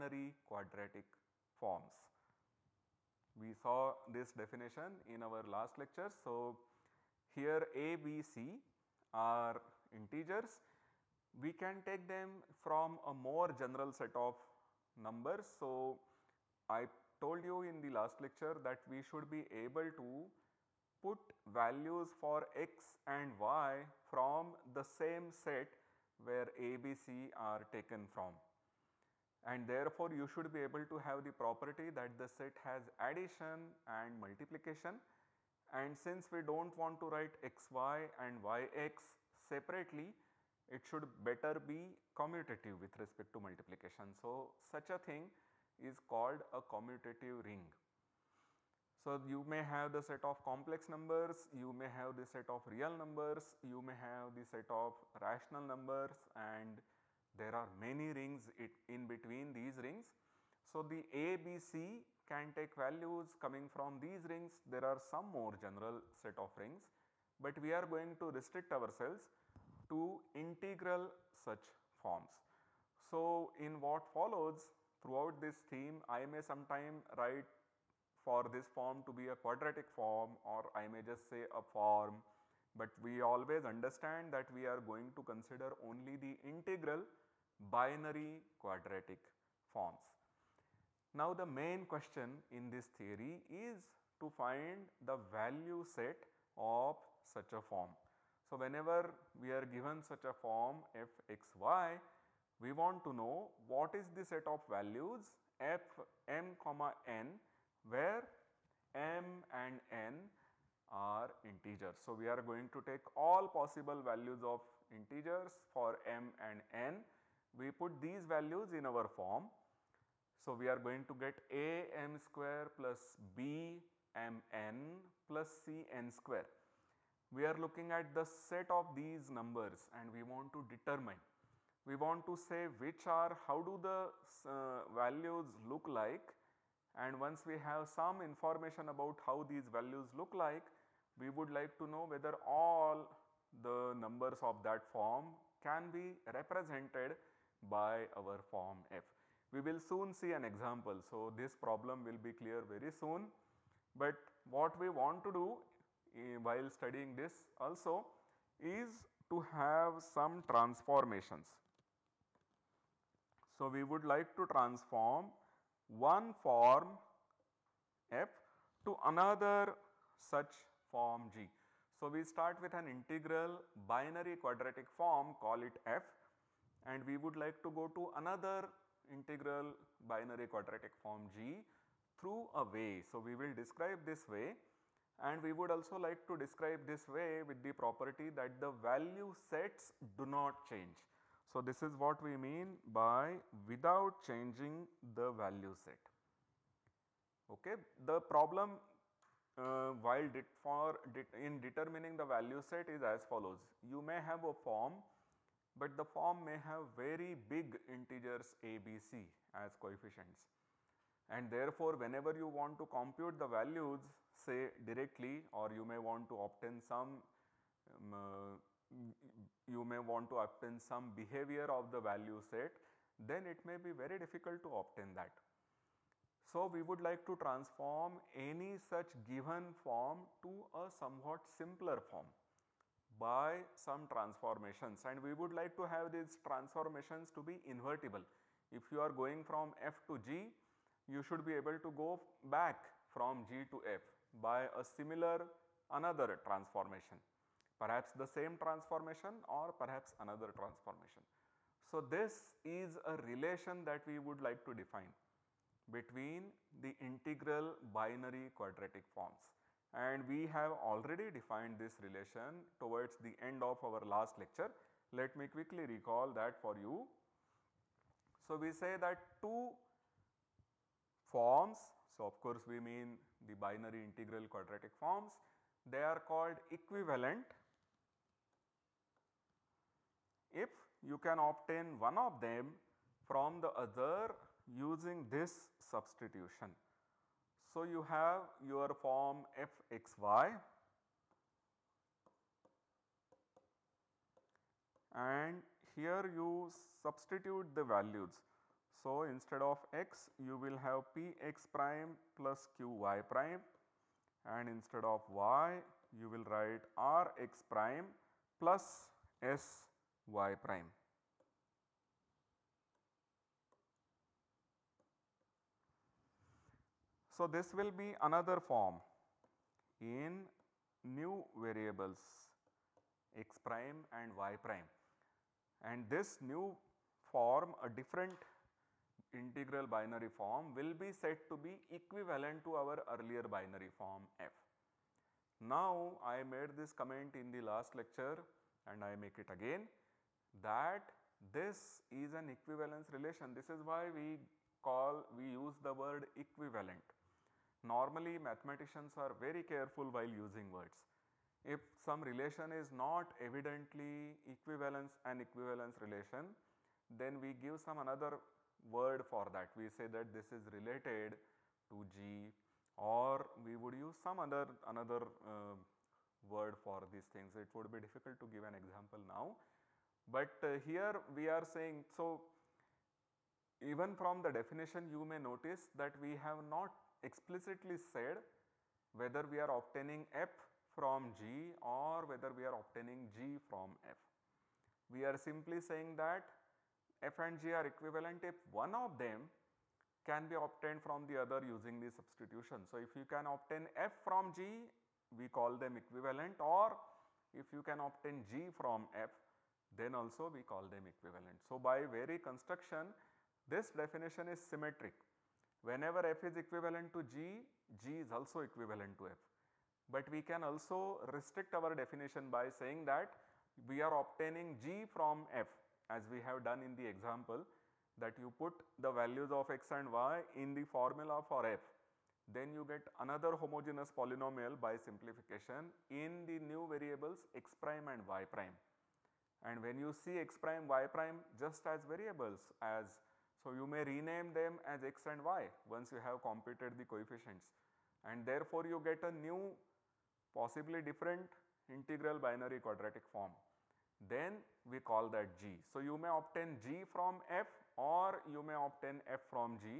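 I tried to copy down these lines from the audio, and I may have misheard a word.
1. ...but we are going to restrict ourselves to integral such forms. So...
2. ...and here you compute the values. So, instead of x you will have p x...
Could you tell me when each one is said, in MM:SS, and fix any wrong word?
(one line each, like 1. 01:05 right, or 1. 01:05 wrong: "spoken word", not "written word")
1. 01:07 right
2. 04:55 wrong: "substitute", not "compute".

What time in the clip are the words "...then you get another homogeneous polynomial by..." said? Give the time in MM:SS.
07:02.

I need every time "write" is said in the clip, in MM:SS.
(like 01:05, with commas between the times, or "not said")
00:37, 01:17, 05:06.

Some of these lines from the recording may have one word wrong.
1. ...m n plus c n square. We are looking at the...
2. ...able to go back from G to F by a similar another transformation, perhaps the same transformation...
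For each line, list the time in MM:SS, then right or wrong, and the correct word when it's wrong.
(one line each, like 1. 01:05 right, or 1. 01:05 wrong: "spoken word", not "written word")
1. 02:04 right
2. 04:01 right.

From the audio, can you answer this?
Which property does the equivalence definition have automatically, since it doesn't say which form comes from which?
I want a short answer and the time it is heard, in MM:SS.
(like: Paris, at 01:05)
symmetric, at 06:44.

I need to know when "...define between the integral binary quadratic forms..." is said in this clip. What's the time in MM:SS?
04:14.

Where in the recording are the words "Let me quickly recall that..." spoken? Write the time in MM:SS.
04:25.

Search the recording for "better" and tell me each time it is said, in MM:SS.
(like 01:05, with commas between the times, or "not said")
00:41.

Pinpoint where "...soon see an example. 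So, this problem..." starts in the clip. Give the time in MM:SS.
02:29.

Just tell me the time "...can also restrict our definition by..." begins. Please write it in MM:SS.
06:50.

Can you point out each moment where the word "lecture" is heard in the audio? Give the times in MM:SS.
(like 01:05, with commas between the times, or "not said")
00:05, 00:18, 04:24, 05:38.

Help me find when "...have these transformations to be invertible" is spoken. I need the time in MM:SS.
03:55.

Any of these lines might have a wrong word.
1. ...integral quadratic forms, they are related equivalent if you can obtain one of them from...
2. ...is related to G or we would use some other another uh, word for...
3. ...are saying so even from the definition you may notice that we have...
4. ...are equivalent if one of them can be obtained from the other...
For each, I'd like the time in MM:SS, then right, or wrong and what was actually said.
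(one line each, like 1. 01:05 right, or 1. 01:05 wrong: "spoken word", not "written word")
1. 04:34 wrong: "called", not "related"
2. 06:00 right
3. 06:11 right
4. 06:27 right.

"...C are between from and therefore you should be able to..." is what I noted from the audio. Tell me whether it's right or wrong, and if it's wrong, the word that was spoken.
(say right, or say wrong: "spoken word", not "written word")
wrong: "taken", not "between".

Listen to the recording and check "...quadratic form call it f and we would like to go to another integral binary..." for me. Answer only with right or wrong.
right.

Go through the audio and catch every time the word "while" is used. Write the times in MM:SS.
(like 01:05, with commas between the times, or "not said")
02:36, 03:20, 05:50.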